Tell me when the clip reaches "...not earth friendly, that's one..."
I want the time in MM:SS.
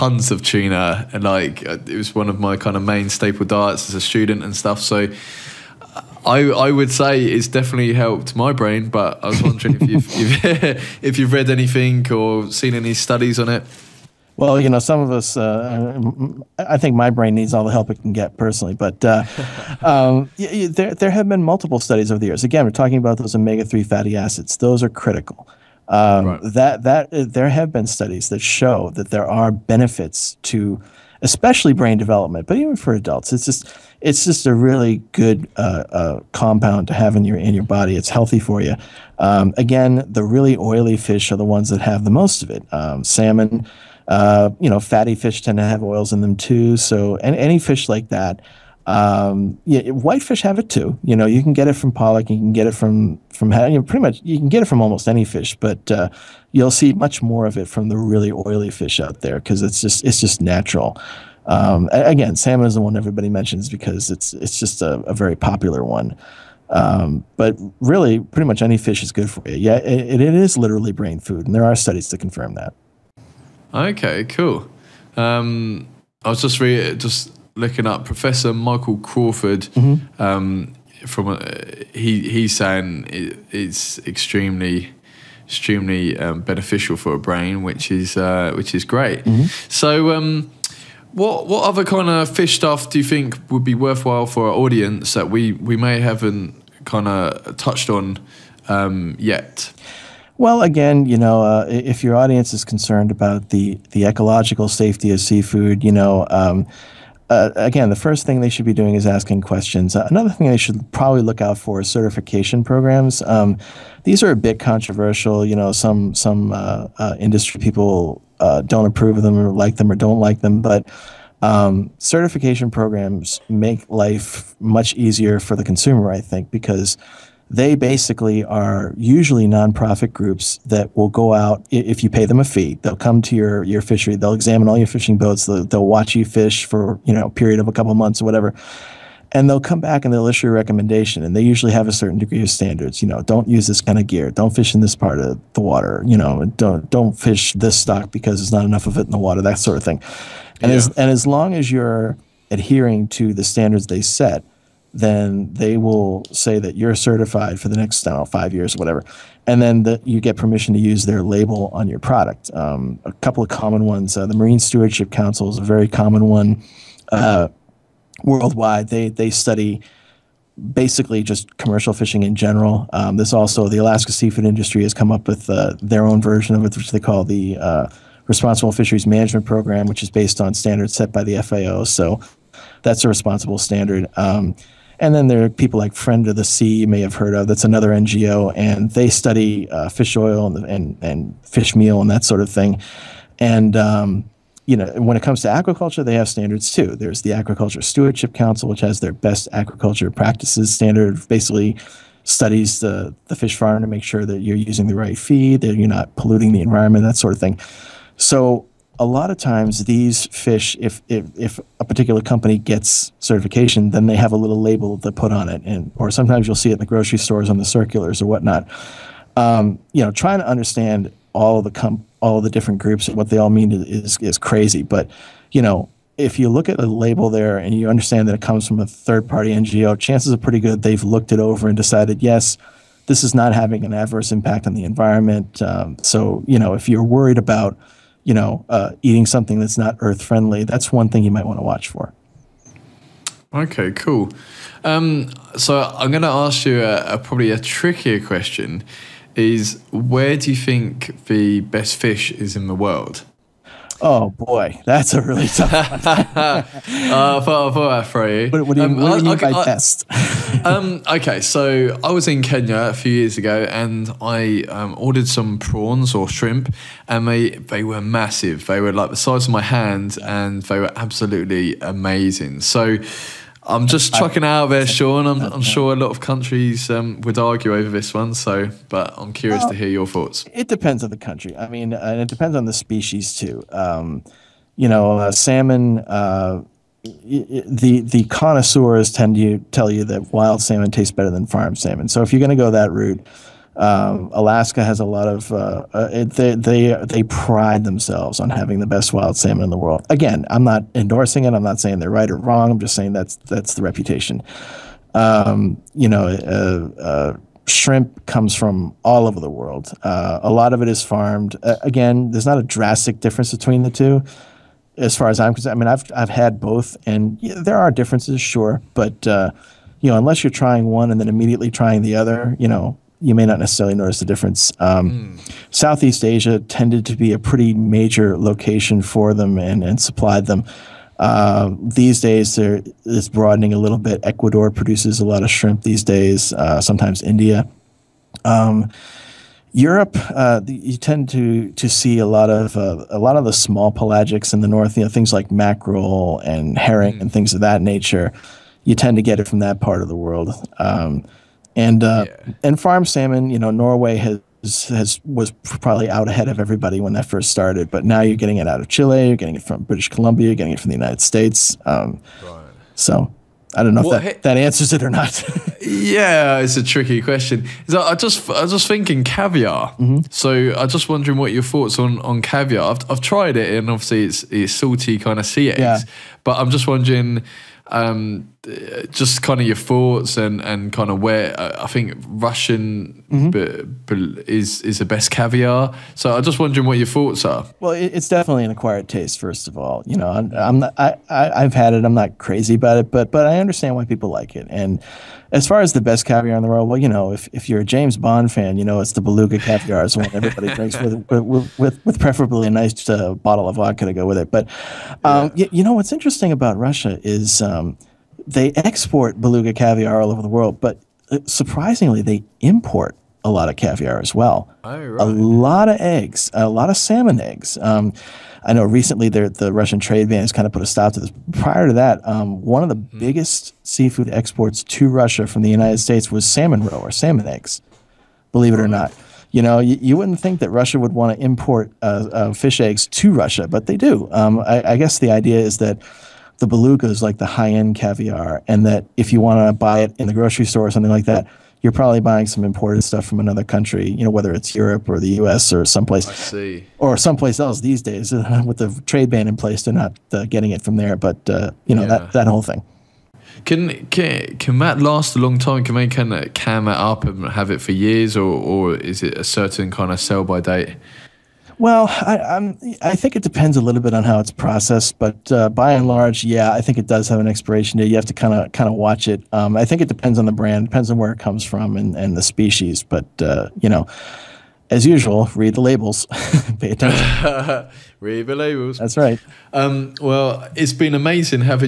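03:59.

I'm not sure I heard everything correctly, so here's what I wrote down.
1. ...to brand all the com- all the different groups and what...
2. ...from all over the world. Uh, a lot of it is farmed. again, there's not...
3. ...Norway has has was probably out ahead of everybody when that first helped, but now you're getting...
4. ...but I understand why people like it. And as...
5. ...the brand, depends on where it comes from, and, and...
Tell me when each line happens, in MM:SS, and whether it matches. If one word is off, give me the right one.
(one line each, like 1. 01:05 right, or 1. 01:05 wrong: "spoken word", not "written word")
1. 03:40 wrong: "understand", not "brand"
2. 05:08 right
3. 05:53 wrong: "started", not "helped"
4. 06:33 right
5. 07:50 right.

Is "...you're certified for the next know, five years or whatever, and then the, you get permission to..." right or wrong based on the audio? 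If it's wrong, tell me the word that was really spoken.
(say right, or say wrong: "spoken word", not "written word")
right.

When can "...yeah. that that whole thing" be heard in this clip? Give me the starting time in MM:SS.
07:32.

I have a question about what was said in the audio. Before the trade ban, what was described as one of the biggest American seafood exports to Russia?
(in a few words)
salmon roe.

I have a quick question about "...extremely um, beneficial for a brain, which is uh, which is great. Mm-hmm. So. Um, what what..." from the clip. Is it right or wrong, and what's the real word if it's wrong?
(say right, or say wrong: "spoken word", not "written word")
right.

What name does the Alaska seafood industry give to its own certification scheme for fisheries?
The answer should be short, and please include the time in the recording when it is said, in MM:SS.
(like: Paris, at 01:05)
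Responsible Fisheries Management Program, at 02:58.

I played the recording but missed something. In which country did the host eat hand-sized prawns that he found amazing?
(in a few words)
Kenya.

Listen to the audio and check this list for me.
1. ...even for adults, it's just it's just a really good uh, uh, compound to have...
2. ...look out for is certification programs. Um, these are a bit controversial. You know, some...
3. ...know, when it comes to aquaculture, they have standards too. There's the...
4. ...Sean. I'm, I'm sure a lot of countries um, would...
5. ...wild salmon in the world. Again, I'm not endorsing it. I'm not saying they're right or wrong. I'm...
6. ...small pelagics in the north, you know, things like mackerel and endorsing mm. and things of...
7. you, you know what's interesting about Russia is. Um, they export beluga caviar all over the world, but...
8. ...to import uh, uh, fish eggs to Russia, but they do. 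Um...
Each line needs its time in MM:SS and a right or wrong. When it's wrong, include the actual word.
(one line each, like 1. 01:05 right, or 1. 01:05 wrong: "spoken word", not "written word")
1. 00:32 right
2. 01:51 right
3. 03:14 right
4. 04:34 right
5. 04:59 right
6. 05:43 wrong: "herring", not "endorsing"
7. 06:45 right
8. 07:11 right.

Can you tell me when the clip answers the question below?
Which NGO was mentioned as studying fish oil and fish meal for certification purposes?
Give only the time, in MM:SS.
03:05.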